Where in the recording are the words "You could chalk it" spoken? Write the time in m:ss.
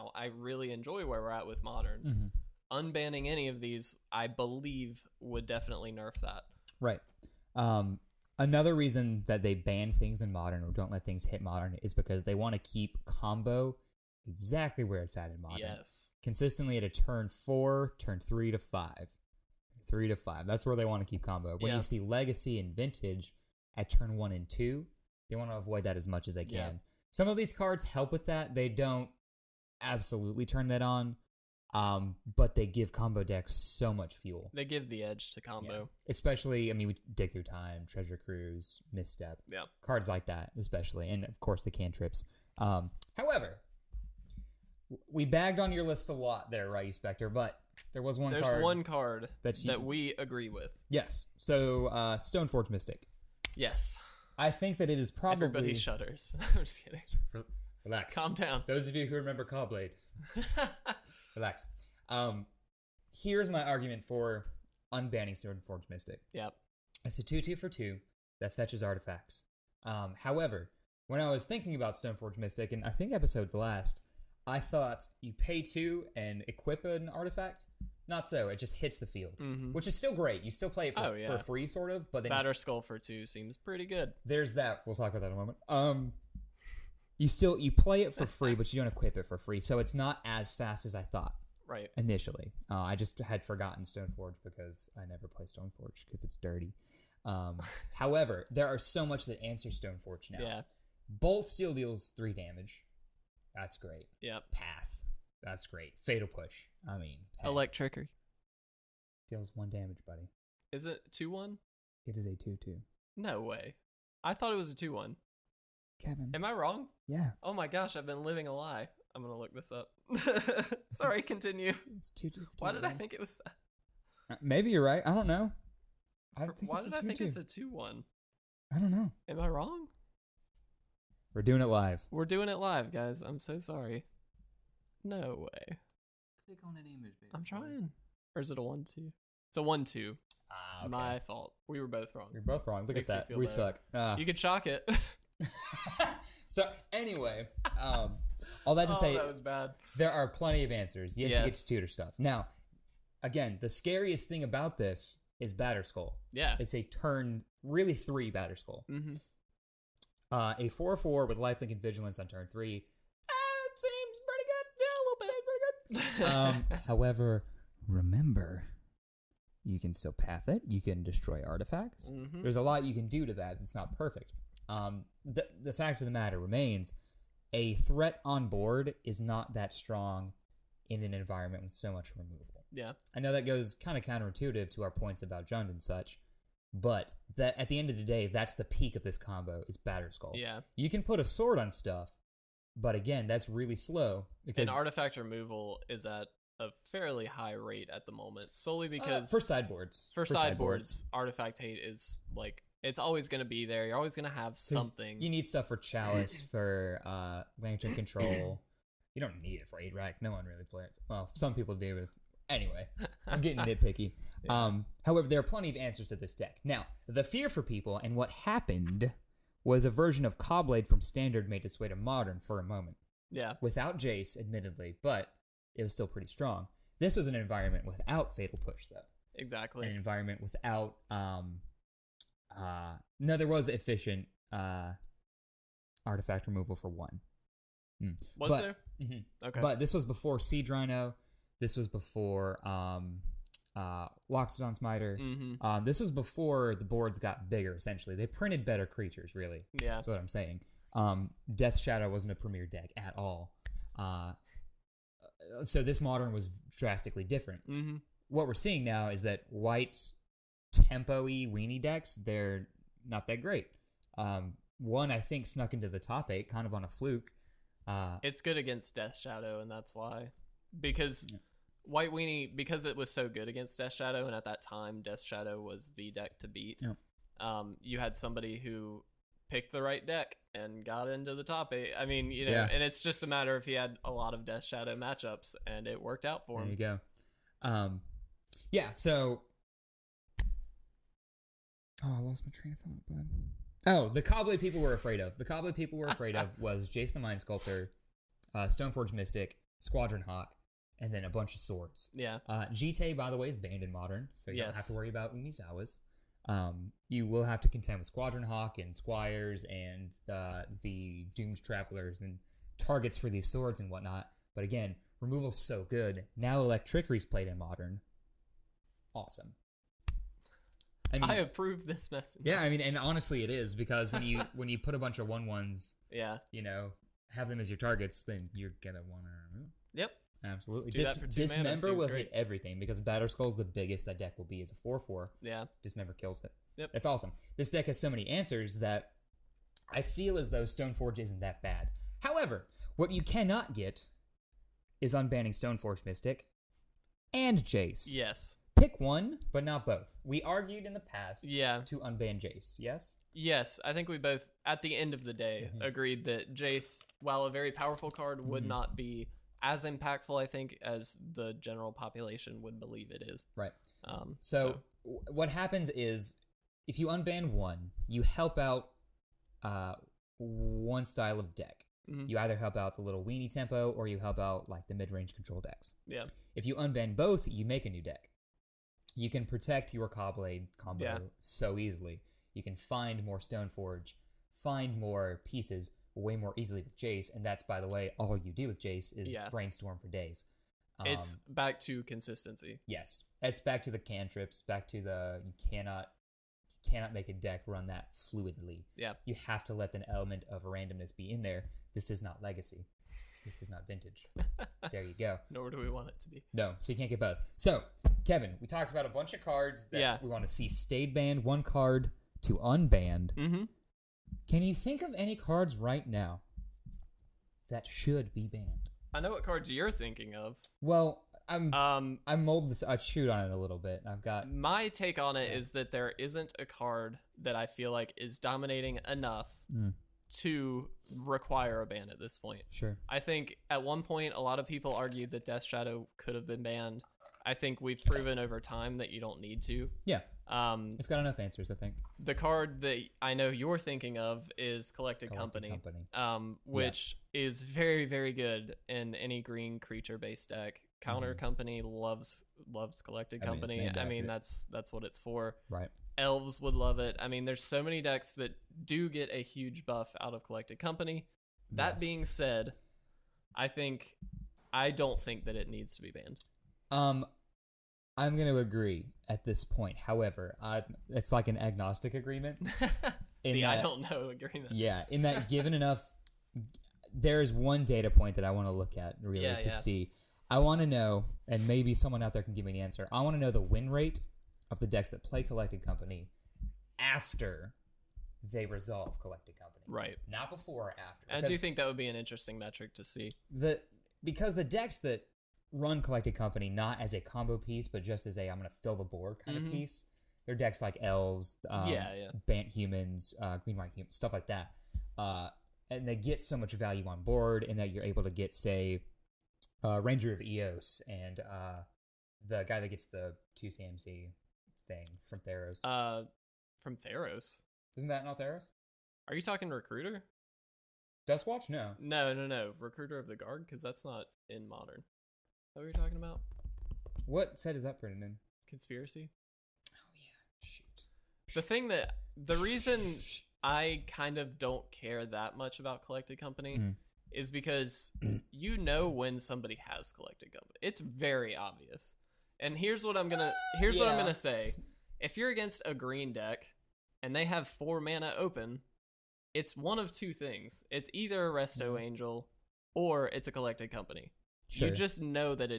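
2:24.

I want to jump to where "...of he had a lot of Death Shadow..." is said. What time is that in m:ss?
4:43.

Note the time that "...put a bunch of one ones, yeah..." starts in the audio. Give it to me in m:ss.
5:24.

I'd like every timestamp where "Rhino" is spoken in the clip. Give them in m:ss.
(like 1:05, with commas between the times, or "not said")
4:00.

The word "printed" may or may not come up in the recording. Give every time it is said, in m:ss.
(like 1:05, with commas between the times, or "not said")
4:08, 8:47.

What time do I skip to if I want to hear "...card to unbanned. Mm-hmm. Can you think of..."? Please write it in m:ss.
6:51.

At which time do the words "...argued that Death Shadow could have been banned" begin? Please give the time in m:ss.
7:14.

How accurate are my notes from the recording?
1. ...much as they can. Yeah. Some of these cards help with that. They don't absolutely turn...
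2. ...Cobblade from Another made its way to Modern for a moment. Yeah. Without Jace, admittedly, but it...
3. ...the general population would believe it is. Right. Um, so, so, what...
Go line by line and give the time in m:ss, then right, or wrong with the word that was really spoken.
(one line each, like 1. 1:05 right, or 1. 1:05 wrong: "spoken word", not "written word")
1. 0:26 right
2. 3:40 wrong: "Standard", not "Another"
3. 6:01 right.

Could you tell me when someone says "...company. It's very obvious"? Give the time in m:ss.
9:00.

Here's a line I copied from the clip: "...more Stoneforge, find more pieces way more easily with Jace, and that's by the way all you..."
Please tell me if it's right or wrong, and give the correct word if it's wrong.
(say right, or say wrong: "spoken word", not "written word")
right.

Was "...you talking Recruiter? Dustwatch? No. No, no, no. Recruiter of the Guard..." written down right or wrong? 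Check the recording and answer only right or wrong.
right.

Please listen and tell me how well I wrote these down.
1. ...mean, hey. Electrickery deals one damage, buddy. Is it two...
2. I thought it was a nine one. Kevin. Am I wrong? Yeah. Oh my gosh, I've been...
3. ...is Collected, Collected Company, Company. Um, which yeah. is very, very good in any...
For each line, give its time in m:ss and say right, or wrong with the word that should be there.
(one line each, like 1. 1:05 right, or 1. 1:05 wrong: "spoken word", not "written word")
1. 1:46 right
2. 1:54 wrong: "two", not "nine"
3. 7:24 right.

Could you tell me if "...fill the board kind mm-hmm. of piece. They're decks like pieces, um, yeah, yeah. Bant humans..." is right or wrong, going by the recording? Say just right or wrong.
wrong.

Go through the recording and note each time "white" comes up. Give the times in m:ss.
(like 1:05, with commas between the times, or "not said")
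4:19, 4:31, 8:23.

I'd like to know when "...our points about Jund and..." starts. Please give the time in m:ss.
3:04.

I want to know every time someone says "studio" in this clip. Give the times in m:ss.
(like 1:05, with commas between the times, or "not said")
not said.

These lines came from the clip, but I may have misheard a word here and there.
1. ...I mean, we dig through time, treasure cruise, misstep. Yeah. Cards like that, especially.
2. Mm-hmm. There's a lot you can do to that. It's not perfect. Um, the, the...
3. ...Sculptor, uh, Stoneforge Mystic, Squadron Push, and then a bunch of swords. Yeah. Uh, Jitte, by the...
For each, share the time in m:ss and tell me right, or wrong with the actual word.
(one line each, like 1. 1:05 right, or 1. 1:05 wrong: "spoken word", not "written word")
1. 0:36 right
2. 2:52 right
3. 4:57 wrong: "Hawk", not "Push".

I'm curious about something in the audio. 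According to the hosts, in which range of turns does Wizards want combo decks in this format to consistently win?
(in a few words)
turn three to five.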